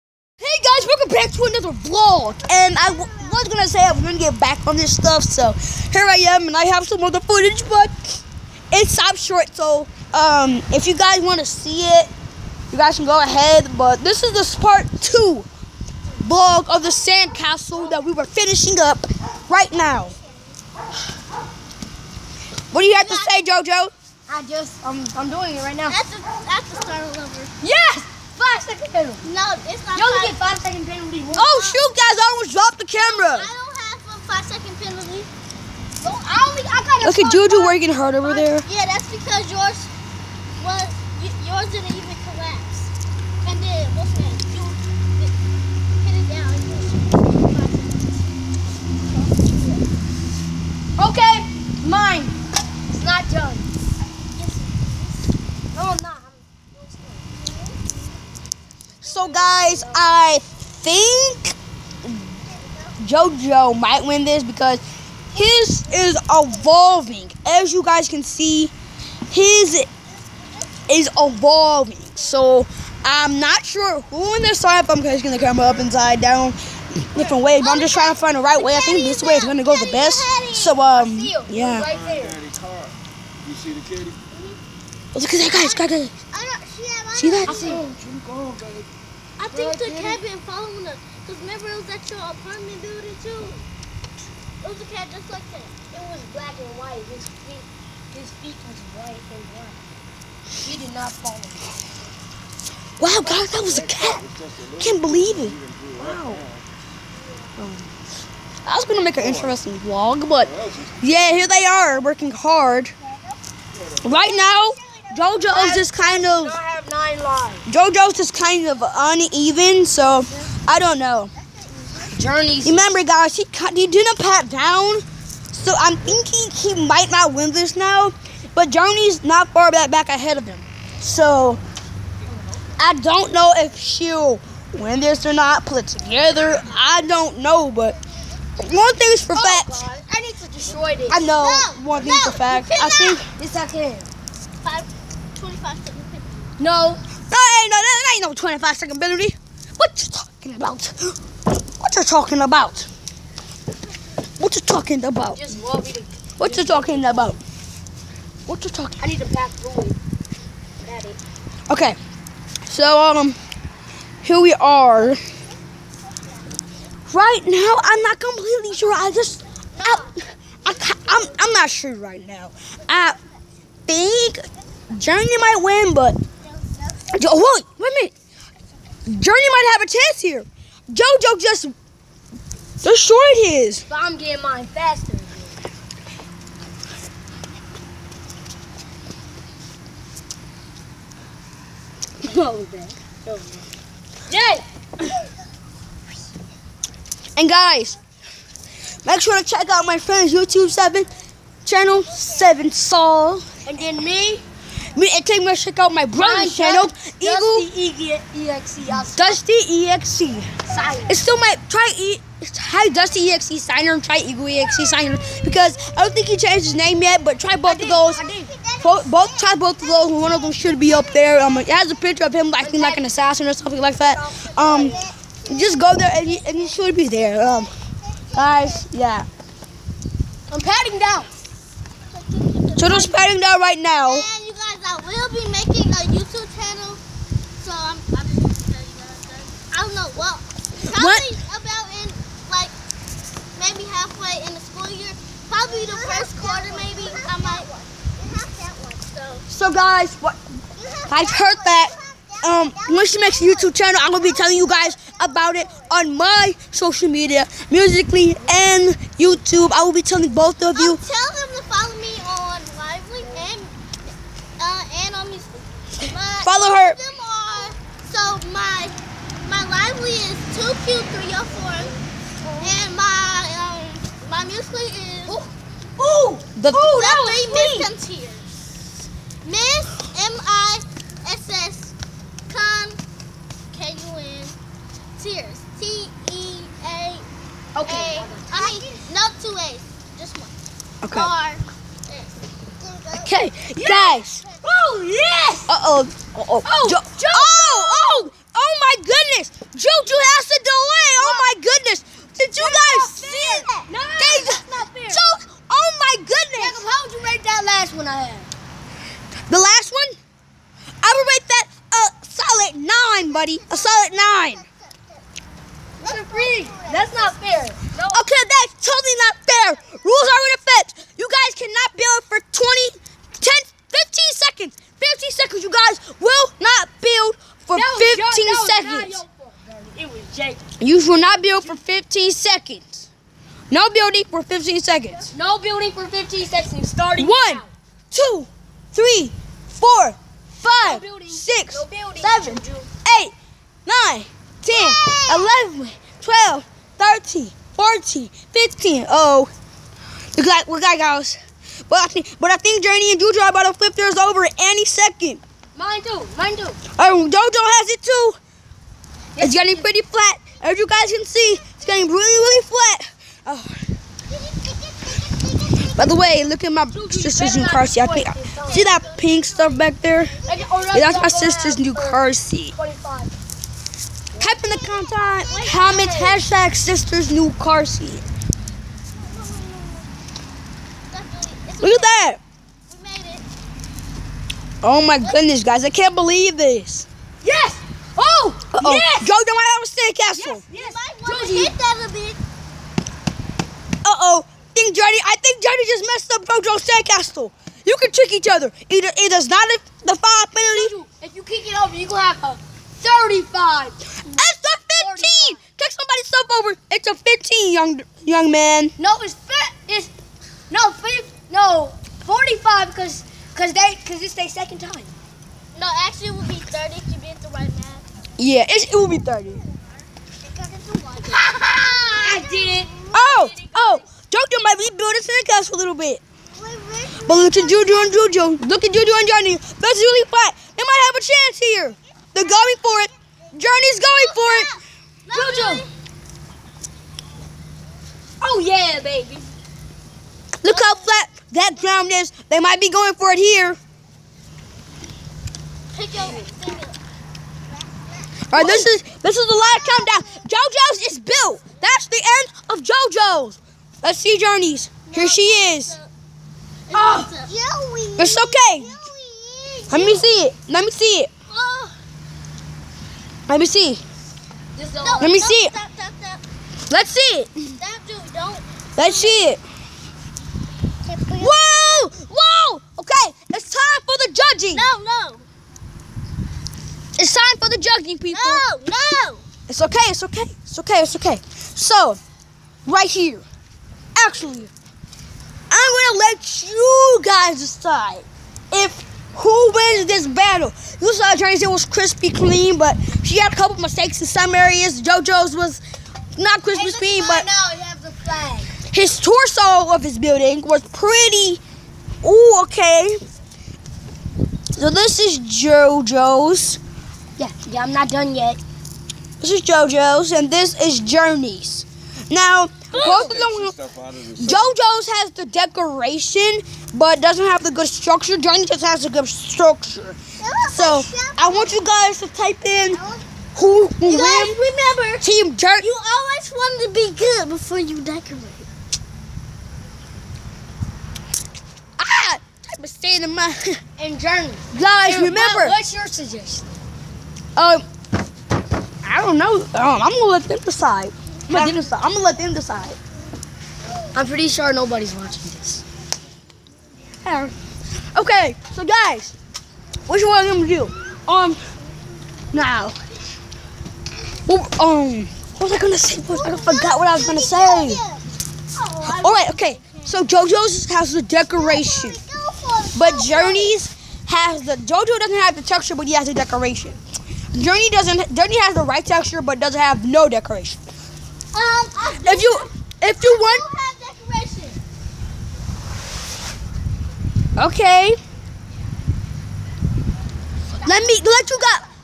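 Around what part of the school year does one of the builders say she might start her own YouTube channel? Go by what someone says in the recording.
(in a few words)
First quarter.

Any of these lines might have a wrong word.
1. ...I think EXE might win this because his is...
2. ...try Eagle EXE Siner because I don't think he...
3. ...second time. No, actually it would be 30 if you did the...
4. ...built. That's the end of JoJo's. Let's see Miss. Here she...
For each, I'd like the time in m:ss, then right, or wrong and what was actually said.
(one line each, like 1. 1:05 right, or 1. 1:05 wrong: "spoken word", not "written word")
1. 0:59 wrong: "JoJo", not "EXE"
2. 3:34 right
3. 6:54 right
4. 7:31 wrong: "Journeys", not "Miss".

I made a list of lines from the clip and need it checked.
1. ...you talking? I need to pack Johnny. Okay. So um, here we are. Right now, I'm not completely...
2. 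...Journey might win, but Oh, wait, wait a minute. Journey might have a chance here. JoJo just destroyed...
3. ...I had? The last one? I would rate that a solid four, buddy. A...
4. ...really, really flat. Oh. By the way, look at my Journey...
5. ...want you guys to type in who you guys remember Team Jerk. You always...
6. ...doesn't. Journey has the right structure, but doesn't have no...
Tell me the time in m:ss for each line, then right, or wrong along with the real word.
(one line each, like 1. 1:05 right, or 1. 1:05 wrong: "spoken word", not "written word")
1. 2:38 wrong: "Daddy", not "Johnny"
2. 2:54 right
3. 5:08 wrong: "nine", not "four"
4. 6:02 wrong: "Juju", not "Journey"
5. 8:41 right
6. 9:27 wrong: "texture", not "structure".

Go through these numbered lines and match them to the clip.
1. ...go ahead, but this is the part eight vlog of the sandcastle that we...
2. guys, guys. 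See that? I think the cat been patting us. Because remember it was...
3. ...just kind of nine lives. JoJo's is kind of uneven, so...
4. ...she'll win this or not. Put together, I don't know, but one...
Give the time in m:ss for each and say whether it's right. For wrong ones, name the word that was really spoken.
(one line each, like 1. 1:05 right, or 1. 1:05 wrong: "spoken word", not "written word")
1. 0:13 wrong: "two", not "eight"
2. 1:25 wrong: "following", not "patting"
3. 1:55 right
4. 2:13 right.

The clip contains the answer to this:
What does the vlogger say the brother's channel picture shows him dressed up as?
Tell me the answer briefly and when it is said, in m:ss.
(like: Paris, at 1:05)
An assassin, at 3:42.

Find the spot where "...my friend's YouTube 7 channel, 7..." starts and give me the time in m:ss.
3:19.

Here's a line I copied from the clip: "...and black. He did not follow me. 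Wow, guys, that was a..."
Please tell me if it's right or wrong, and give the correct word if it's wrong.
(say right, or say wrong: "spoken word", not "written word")
right.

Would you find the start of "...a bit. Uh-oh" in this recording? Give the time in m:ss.
6:32.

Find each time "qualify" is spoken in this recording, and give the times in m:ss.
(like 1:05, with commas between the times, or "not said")
not said.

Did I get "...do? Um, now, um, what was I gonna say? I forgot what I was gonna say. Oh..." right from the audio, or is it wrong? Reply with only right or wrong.
right.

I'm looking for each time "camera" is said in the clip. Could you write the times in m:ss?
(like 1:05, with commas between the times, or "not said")
0:32, 1:15.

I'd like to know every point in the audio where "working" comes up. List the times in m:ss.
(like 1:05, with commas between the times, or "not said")
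0:37, 1:51.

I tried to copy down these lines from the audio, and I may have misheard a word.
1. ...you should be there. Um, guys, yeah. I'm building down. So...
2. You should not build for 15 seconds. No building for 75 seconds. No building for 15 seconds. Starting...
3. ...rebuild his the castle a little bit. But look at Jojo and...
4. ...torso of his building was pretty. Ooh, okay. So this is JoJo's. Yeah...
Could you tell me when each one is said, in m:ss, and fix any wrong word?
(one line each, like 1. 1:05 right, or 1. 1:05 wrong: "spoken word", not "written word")
1. 3:46 wrong: "patting", not "building"
2. 5:30 wrong: "15", not "75"
3. 7:04 right
4. 8:19 right.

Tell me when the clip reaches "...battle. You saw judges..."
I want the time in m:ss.
8:10.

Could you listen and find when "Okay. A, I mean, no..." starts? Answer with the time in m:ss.
4:47.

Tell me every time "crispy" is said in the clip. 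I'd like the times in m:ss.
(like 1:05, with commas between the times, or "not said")
8:11, 8:16.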